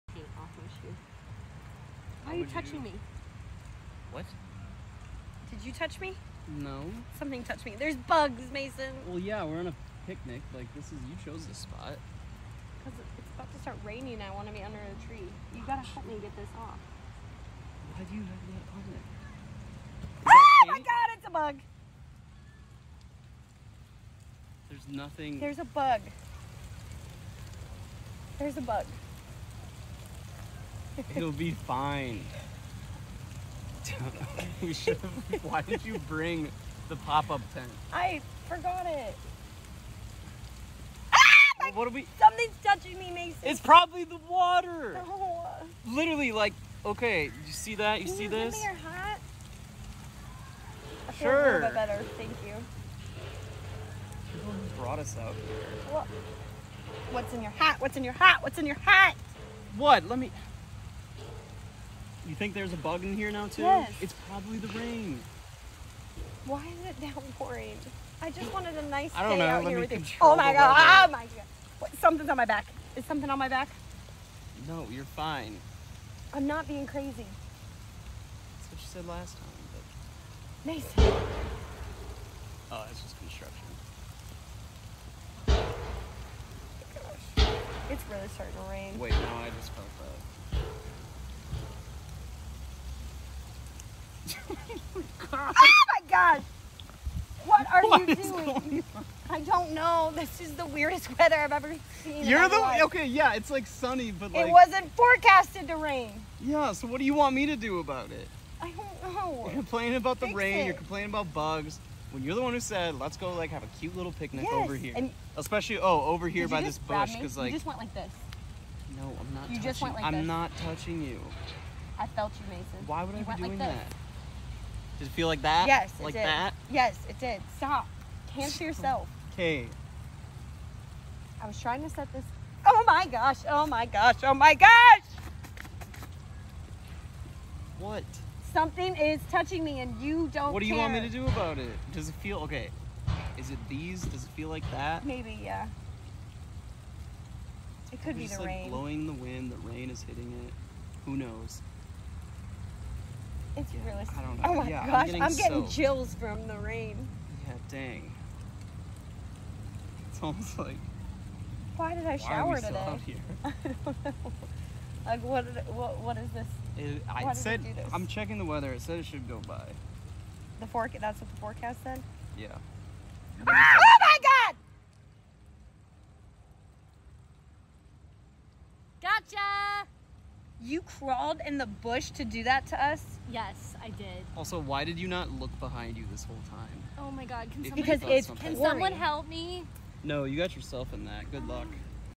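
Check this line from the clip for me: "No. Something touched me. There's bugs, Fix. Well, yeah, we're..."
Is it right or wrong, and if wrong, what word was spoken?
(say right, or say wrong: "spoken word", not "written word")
wrong: "Mason", not "Fix".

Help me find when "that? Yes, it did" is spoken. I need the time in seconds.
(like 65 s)
126 s.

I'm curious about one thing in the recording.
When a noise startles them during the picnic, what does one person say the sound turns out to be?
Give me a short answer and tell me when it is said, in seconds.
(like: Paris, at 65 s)
construction, at 83 s.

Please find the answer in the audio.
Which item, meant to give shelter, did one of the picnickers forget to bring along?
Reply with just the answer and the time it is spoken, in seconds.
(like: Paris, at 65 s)
pop-up tent, at 36 s.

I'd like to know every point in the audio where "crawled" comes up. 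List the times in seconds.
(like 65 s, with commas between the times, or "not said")
180 s.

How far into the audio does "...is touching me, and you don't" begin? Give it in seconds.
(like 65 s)
138 s.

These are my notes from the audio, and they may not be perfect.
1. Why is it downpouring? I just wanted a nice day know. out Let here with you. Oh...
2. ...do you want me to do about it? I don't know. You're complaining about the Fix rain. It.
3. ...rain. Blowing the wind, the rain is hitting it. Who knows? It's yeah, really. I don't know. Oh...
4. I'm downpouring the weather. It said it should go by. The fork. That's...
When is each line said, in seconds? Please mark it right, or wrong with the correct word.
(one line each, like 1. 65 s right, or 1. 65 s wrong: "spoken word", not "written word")
1. 66 s right
2. 106 s right
3. 148 s right
4. 167 s wrong: "checking", not "downpouring".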